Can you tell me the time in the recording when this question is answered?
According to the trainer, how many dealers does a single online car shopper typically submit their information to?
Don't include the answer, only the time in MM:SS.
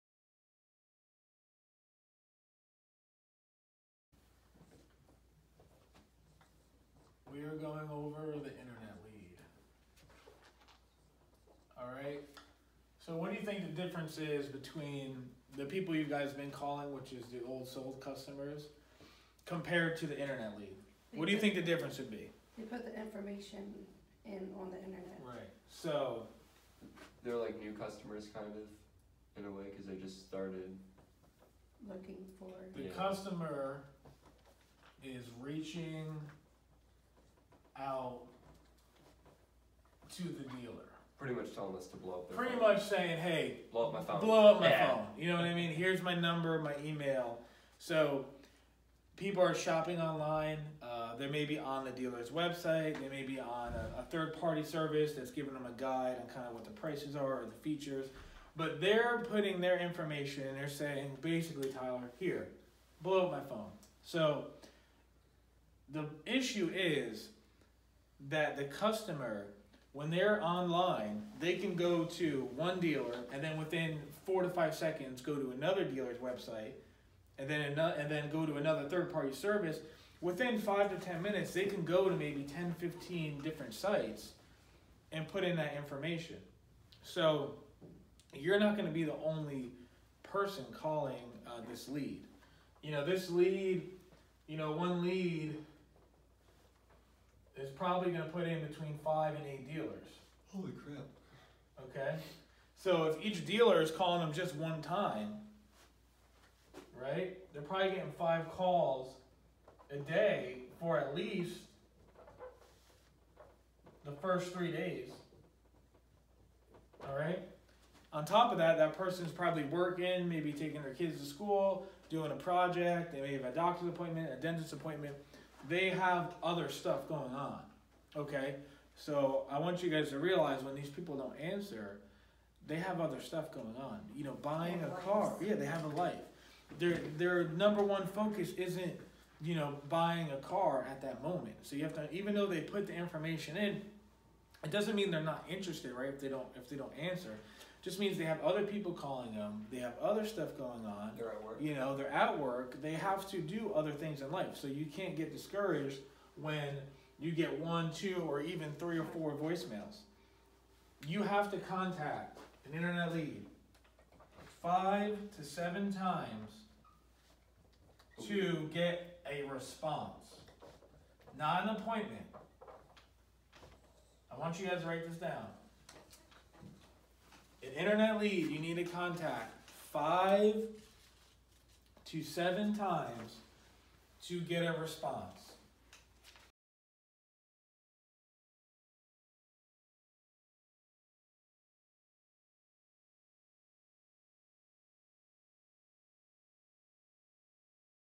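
01:38.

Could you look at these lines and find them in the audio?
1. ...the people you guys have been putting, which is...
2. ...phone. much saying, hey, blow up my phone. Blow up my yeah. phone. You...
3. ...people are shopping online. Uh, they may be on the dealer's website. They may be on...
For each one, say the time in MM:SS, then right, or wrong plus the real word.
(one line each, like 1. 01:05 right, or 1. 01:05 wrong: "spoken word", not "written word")
1. 00:15 wrong: "calling", not "putting"
2. 00:42 right
3. 00:49 right.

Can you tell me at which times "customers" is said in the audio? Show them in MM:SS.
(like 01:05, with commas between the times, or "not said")
00:18, 00:27, 00:32, 01:08.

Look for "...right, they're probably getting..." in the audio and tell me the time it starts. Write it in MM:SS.
01:47.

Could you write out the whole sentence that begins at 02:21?
So you have to even though they put the information in, it doesn't mean they're not interested, right?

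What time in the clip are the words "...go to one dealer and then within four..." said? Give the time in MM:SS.
01:11.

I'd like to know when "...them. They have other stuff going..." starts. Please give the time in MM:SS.
02:29.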